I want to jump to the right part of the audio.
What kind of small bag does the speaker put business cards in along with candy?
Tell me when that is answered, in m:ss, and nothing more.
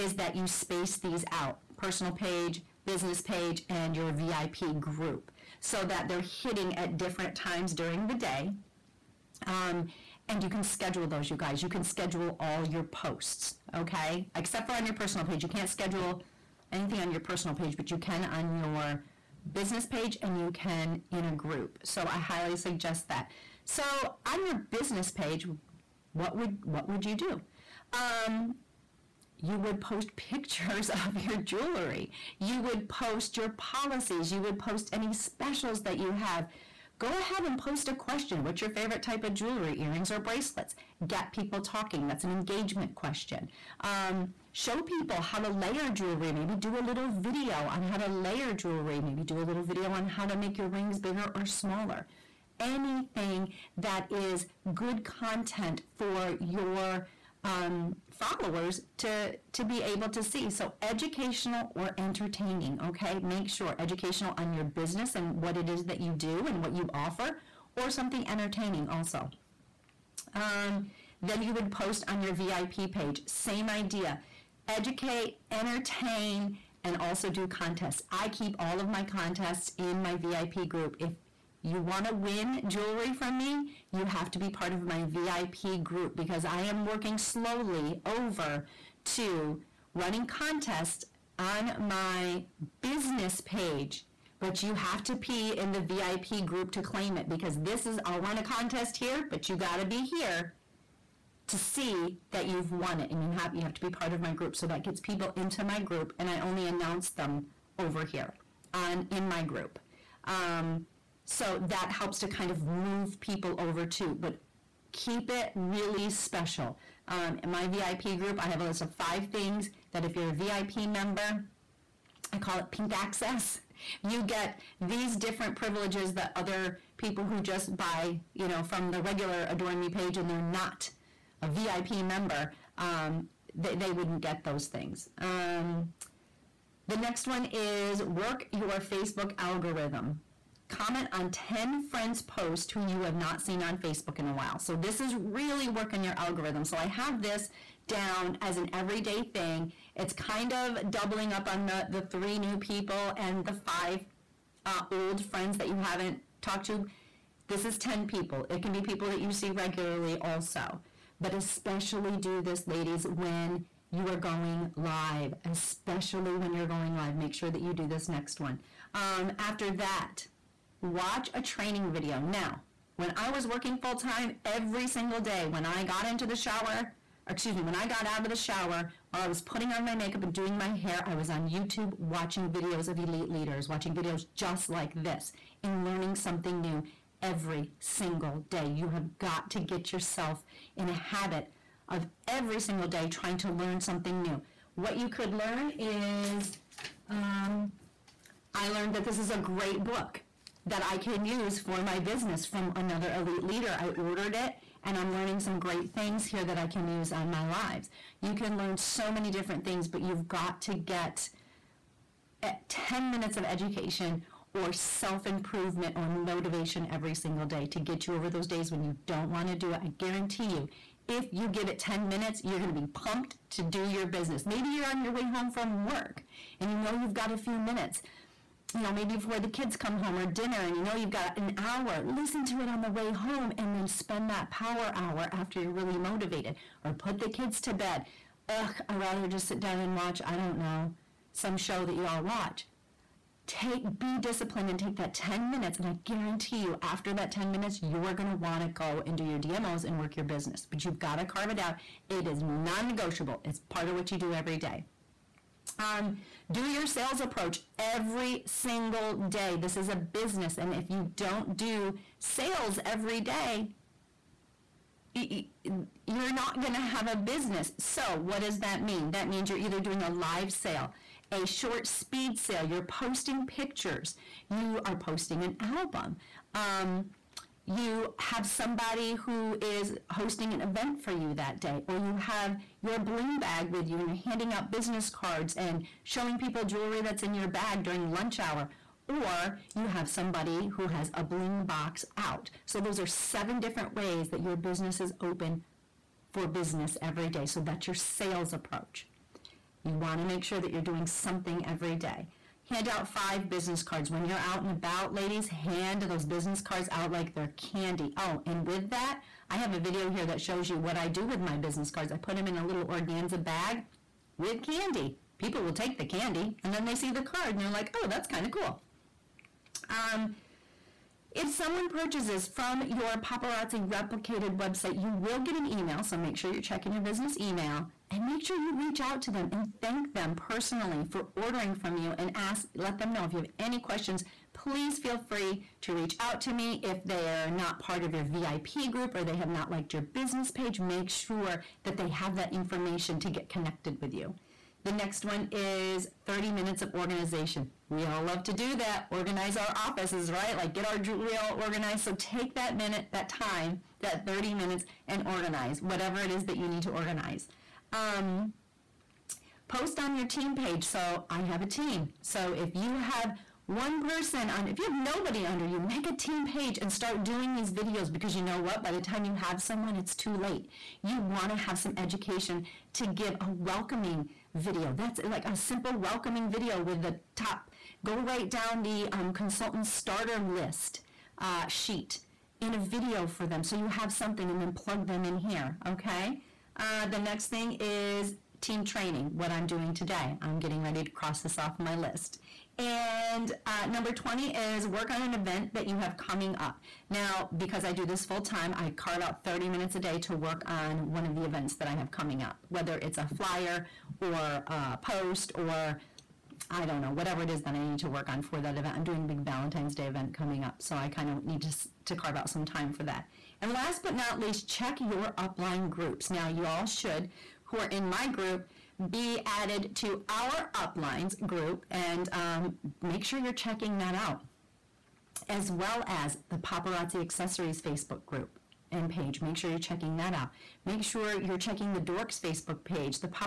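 5:12.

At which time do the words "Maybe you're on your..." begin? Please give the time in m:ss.
3:44.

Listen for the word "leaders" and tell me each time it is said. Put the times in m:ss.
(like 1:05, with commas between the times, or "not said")
3:03, 3:23.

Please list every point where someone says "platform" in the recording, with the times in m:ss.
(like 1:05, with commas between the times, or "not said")
not said.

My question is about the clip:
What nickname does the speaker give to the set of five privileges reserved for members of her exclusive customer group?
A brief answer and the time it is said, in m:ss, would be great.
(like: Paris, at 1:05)
Pink access, at 2:02.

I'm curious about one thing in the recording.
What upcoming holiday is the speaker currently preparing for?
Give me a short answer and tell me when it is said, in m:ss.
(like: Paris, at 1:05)
Valentine's Day, at 6:49.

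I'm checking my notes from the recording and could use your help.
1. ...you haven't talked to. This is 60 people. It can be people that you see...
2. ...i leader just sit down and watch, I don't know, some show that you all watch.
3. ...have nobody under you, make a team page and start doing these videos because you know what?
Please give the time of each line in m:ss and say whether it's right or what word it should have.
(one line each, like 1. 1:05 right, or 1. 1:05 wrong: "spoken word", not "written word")
1. 2:35 wrong: "10", not "60"
2. 3:58 wrong: "rather", not "leader"
3. 6:04 right.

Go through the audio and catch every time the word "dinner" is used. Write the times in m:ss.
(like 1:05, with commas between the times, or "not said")
3:50.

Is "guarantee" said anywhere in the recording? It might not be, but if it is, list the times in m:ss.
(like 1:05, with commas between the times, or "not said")
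3:39, 4:06.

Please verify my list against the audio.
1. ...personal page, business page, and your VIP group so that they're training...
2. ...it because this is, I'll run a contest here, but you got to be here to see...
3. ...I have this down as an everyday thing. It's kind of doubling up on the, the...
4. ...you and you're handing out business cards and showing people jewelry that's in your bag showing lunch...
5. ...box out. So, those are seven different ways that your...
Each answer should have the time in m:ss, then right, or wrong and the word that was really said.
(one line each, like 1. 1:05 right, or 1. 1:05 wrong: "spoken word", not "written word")
1. 0:01 wrong: "hitting", not "training"
2. 1:37 right
3. 2:26 right
4. 4:43 wrong: "during", not "showing"
5. 4:51 right.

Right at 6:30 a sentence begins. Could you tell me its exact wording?
I'm getting ready to cross this off my list.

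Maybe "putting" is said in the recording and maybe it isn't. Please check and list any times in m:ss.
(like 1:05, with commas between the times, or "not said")
2:59.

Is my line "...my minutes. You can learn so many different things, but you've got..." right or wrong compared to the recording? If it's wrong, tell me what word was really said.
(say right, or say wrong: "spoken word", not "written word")
wrong: "lives", not "minutes".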